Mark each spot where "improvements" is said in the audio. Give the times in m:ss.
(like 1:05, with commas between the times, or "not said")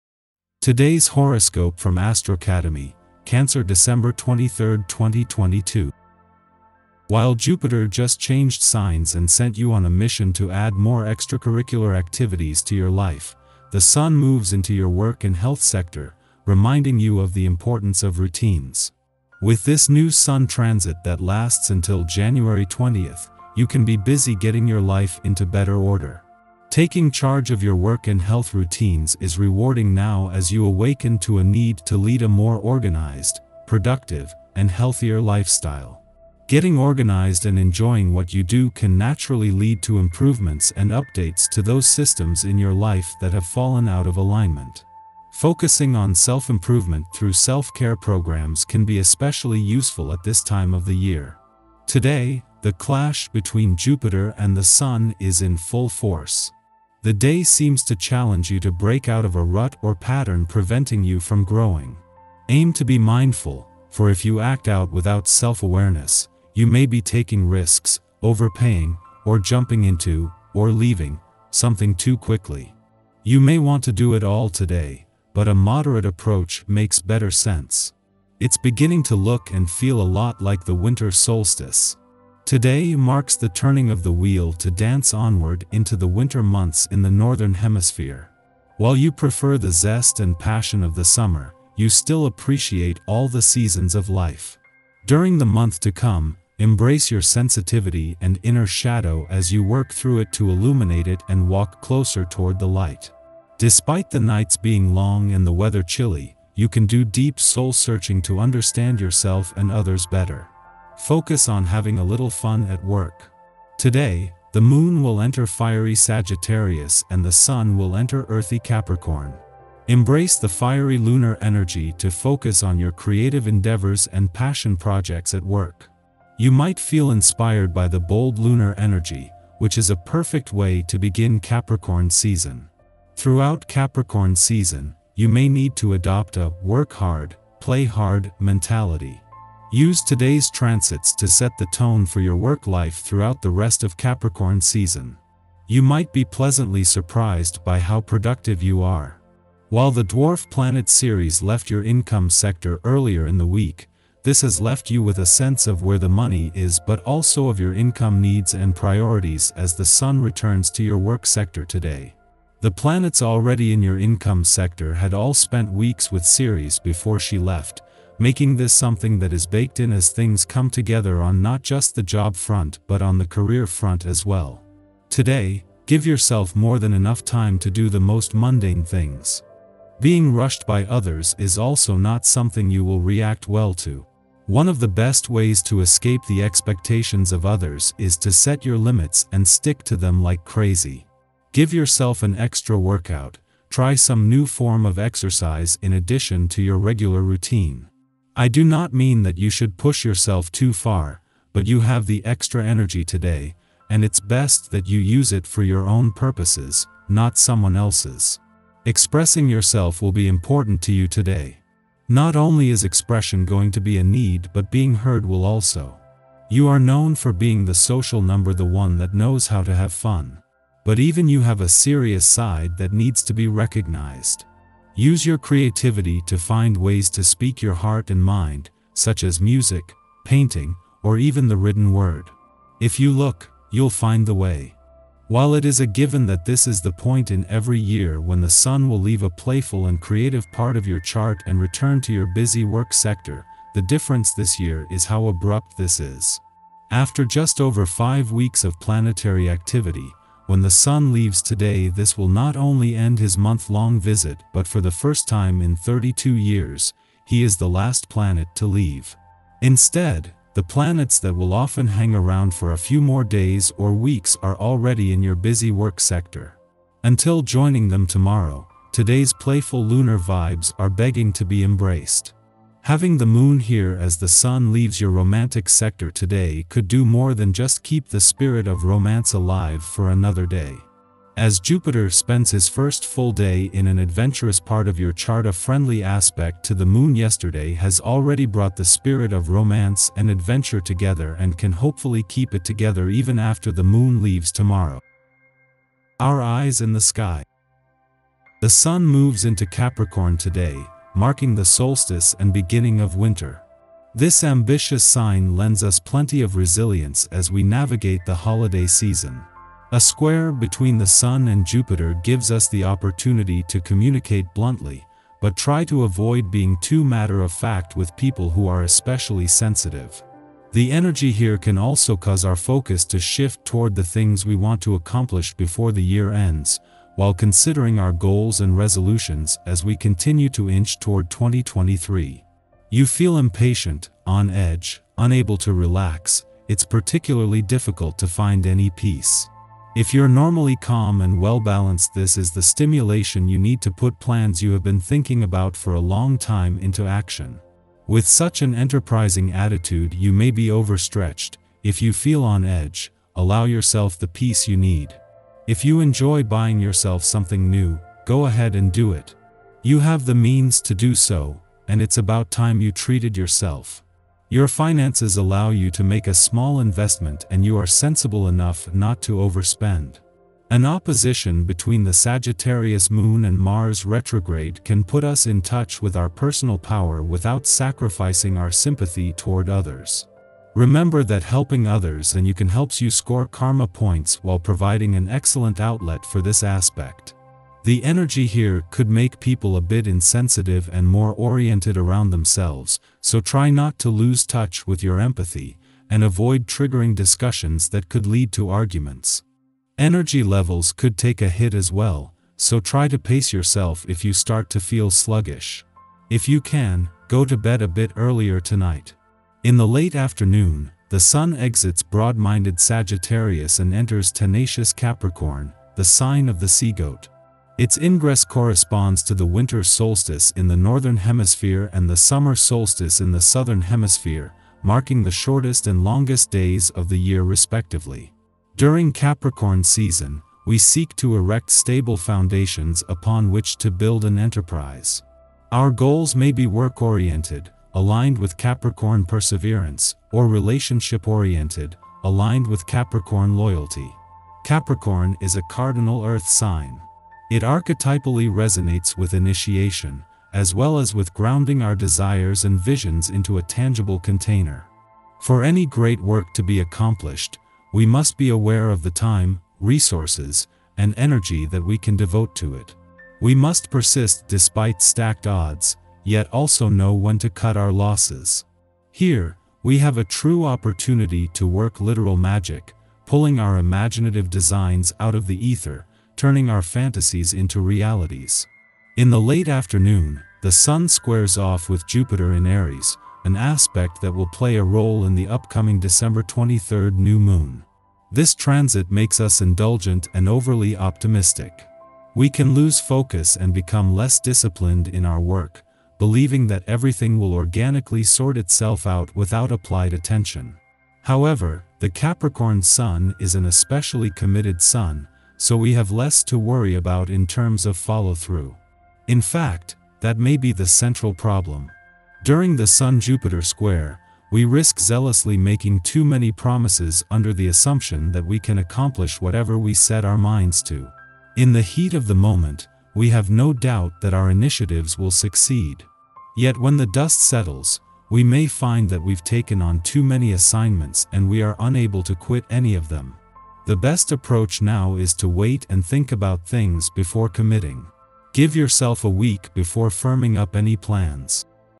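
0:39, 0:46.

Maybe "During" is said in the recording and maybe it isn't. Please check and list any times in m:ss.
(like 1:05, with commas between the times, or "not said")
1:35, 7:08, 8:32.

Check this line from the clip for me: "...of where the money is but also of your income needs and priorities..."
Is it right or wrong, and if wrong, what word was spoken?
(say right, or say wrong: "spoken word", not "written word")
right.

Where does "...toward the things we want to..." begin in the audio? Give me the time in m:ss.
5:23.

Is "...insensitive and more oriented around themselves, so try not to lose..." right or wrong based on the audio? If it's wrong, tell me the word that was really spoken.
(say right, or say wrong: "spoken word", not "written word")
right.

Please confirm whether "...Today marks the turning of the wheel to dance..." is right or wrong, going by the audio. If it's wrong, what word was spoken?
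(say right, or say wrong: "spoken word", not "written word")
right.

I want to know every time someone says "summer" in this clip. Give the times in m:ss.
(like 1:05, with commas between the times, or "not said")
1:31, 7:02.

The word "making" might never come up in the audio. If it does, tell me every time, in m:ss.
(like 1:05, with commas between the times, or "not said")
2:48, 8:35.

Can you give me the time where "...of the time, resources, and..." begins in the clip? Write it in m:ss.
7:38.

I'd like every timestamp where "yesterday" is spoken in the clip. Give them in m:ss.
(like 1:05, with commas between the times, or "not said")
4:47.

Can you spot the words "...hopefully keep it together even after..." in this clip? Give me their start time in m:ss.
4:51.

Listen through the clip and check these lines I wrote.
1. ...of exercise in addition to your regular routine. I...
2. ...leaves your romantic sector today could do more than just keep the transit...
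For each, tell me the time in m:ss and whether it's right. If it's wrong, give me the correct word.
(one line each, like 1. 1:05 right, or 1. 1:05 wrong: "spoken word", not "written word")
1. 3:14 right
2. 4:34 wrong: "spirit", not "transit".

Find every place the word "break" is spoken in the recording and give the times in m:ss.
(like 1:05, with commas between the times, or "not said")
0:58.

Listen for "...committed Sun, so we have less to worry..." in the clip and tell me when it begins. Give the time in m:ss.
8:24.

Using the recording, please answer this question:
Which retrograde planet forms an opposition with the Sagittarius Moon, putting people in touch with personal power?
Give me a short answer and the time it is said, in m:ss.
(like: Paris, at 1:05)
Mars, at 6:13.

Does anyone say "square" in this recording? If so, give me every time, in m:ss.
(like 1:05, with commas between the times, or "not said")
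5:09, 8:01, 8:33.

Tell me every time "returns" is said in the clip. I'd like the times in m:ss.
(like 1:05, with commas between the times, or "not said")
2:40, 4:01.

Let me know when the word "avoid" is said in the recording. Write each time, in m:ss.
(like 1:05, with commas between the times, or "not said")
5:16, 6:36.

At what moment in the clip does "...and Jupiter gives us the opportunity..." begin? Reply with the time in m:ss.
5:11.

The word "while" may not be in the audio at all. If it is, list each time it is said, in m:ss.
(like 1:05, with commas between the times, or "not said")
0:07, 1:28, 2:29, 3:55, 5:27, 6:24.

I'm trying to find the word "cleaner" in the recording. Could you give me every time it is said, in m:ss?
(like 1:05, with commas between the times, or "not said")
not said.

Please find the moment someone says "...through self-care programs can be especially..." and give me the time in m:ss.
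0:47.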